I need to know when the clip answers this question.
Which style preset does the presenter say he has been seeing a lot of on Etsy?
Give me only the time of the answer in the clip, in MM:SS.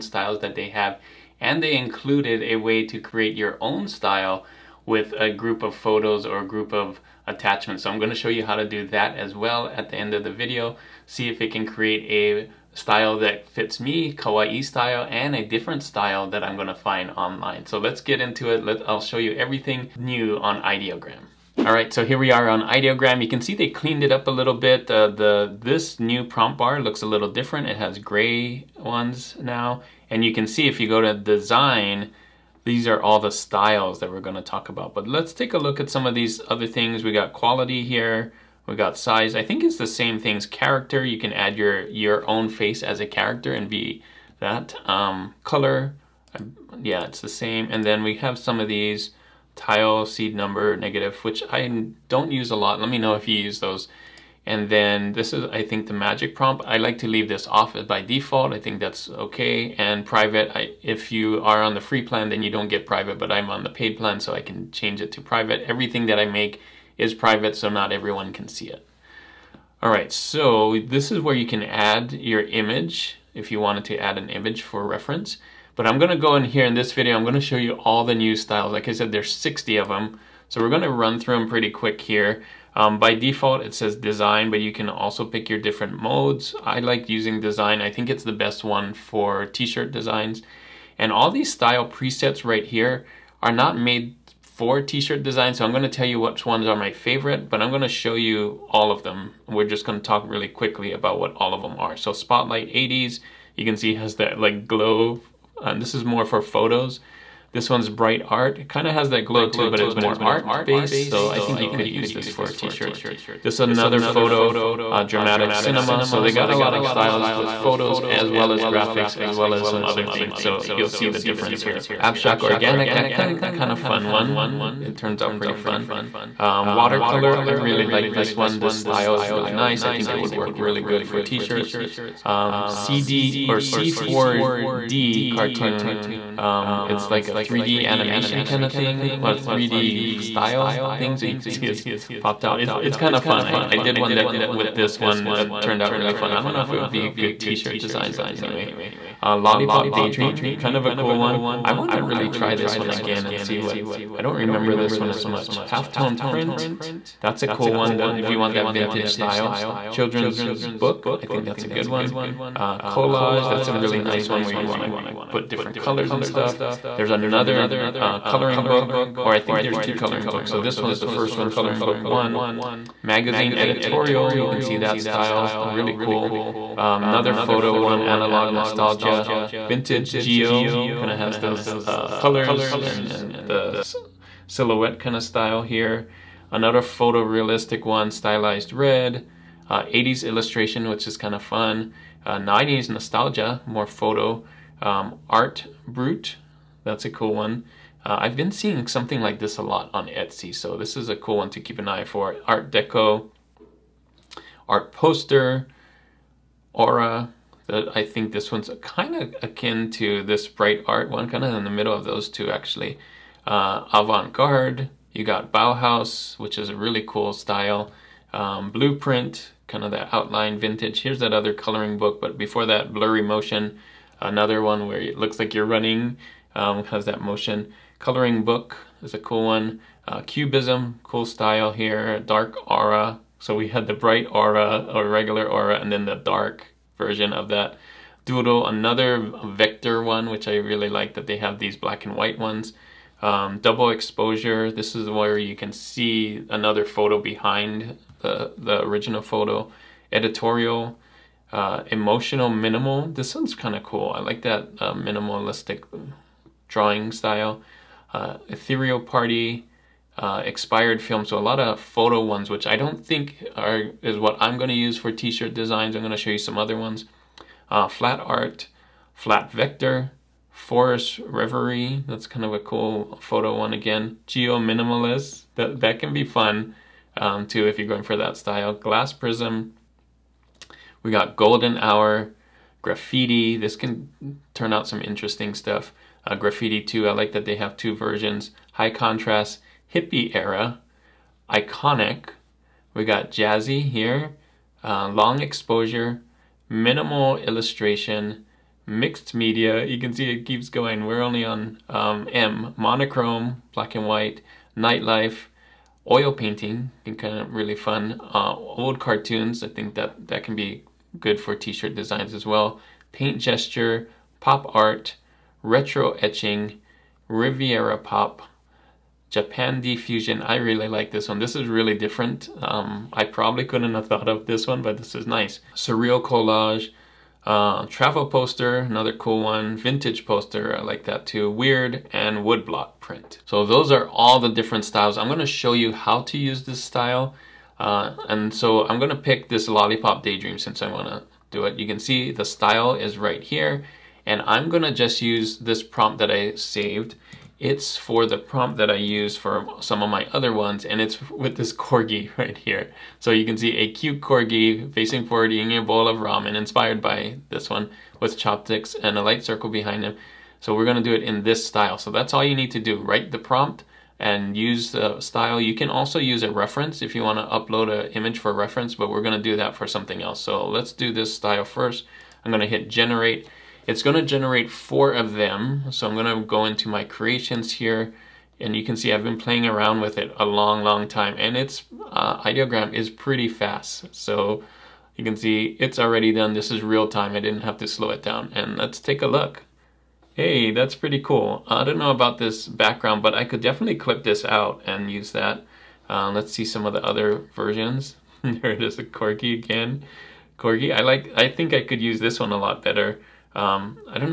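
03:15.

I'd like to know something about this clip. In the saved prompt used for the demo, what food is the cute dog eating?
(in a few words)
ramen.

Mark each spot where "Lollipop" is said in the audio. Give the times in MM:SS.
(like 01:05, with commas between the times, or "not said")
02:29, 05:39.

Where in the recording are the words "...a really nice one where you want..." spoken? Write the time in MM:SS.
02:43.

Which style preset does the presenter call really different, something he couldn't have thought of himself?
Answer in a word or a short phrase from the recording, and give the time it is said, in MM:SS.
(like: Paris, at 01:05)
Japandi Fusion, at 05:19.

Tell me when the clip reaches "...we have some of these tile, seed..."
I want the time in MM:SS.
00:48.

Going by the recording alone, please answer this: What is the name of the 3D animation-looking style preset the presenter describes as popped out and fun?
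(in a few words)
C4D cartoon.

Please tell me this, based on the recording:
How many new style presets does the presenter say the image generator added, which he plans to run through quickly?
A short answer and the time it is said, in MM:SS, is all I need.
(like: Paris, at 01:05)
60, at 01:19.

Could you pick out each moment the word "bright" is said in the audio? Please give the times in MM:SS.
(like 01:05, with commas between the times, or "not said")
01:47, 03:30, 03:53.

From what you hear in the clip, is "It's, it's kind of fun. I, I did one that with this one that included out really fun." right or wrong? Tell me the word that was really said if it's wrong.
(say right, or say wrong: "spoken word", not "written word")
wrong: "turned", not "included".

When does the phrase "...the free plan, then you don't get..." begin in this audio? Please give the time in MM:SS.
01:01.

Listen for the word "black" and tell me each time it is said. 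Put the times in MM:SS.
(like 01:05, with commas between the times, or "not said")
04:01, 05:03.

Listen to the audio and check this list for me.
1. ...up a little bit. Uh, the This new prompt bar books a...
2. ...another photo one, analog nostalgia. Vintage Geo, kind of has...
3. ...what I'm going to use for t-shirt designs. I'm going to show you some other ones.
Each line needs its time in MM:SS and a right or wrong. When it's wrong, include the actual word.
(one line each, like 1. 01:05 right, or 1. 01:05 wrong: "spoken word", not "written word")
1. 00:24 wrong: "looks", not "books"
2. 02:57 right
3. 04:24 right.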